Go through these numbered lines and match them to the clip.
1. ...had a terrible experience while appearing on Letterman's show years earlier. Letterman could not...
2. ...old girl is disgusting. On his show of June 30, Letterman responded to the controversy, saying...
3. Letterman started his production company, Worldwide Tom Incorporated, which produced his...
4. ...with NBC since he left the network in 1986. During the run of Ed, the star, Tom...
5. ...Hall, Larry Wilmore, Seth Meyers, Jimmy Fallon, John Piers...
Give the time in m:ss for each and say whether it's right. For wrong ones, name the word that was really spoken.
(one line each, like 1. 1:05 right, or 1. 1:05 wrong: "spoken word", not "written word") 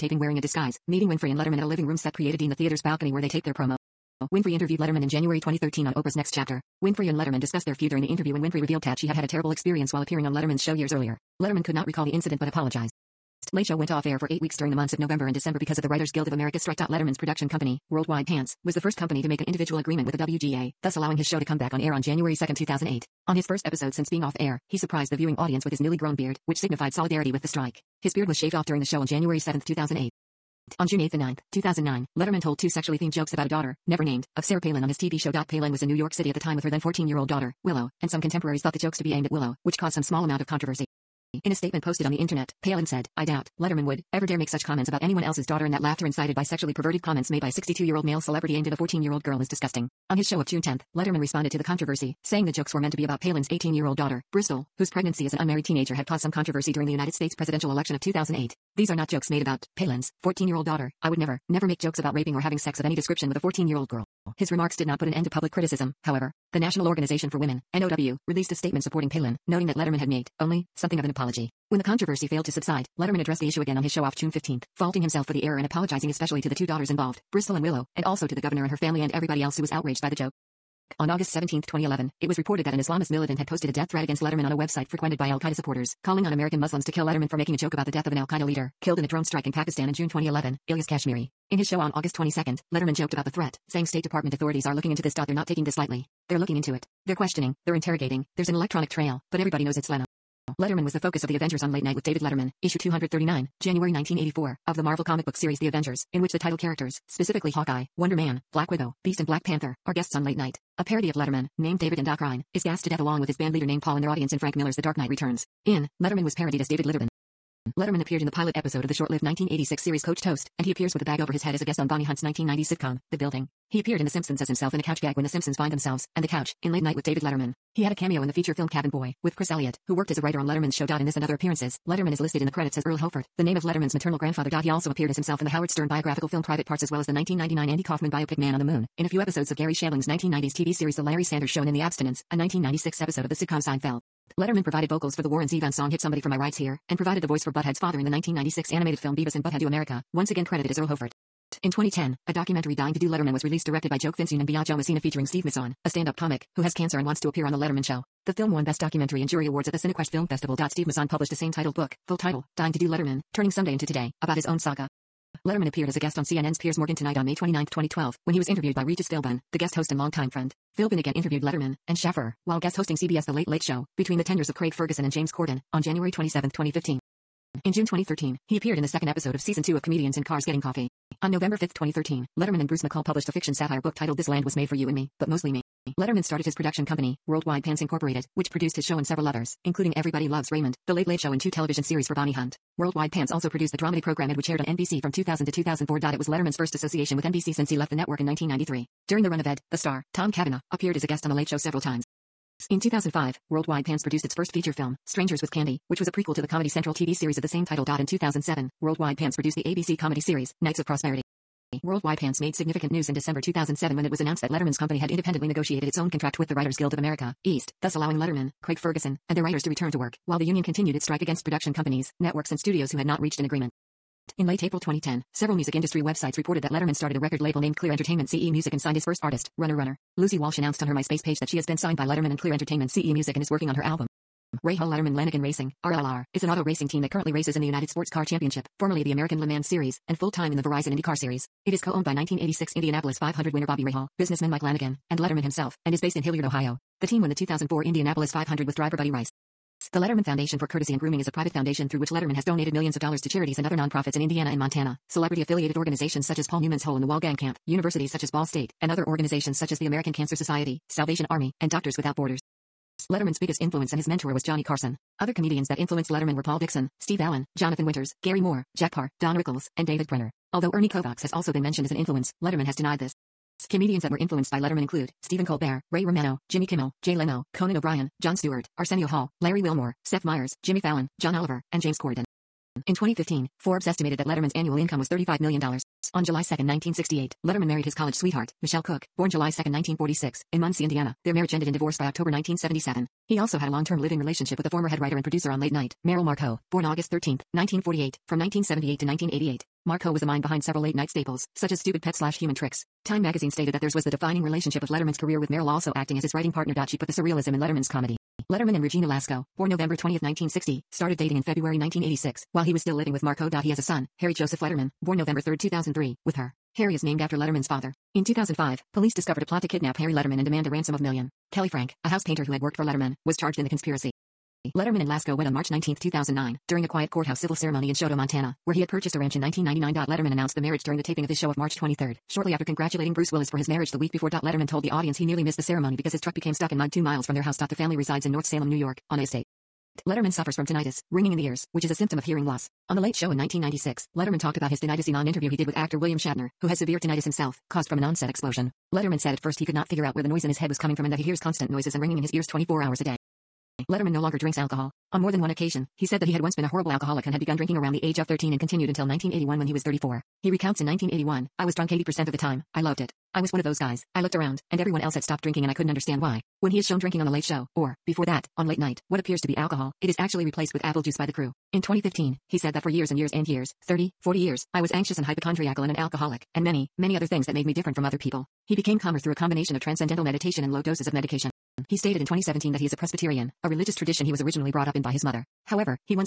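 1. 0:09 right
2. 0:49 wrong: "10", not "30"
3. 3:05 wrong: "Pants", not "Tom"
4. 3:17 wrong: "1993", not "1986"
5. 4:39 wrong: "Oliver", not "Piers".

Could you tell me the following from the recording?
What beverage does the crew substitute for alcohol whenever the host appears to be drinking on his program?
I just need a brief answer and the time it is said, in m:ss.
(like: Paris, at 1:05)
apple juice, at 6:10.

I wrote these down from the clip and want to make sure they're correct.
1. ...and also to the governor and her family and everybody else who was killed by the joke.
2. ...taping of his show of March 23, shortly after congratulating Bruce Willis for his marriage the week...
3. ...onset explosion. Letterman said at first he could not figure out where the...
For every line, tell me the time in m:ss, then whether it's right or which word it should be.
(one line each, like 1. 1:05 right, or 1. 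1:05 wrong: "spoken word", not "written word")
1. 1:17 wrong: "outraged", not "killed"
2. 5:31 right
3. 5:48 right.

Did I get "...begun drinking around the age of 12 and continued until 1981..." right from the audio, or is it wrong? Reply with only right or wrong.
wrong.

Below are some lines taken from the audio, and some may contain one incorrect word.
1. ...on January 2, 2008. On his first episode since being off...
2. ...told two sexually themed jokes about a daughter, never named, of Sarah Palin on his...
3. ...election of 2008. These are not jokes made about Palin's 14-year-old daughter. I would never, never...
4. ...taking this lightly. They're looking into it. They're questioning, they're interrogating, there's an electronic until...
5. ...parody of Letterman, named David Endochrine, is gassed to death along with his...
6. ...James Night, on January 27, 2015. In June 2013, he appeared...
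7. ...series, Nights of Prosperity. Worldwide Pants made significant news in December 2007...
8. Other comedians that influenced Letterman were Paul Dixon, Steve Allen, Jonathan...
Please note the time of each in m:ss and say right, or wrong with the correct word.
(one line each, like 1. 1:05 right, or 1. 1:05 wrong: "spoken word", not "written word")
1. 0:21 right
2. 0:32 right
3. 0:57 right
4. 1:35 wrong: "trail", not "until"
5. 1:50 right
6. 2:55 wrong: "Corden", not "Night"
7. 3:30 right
8. 4:25 right.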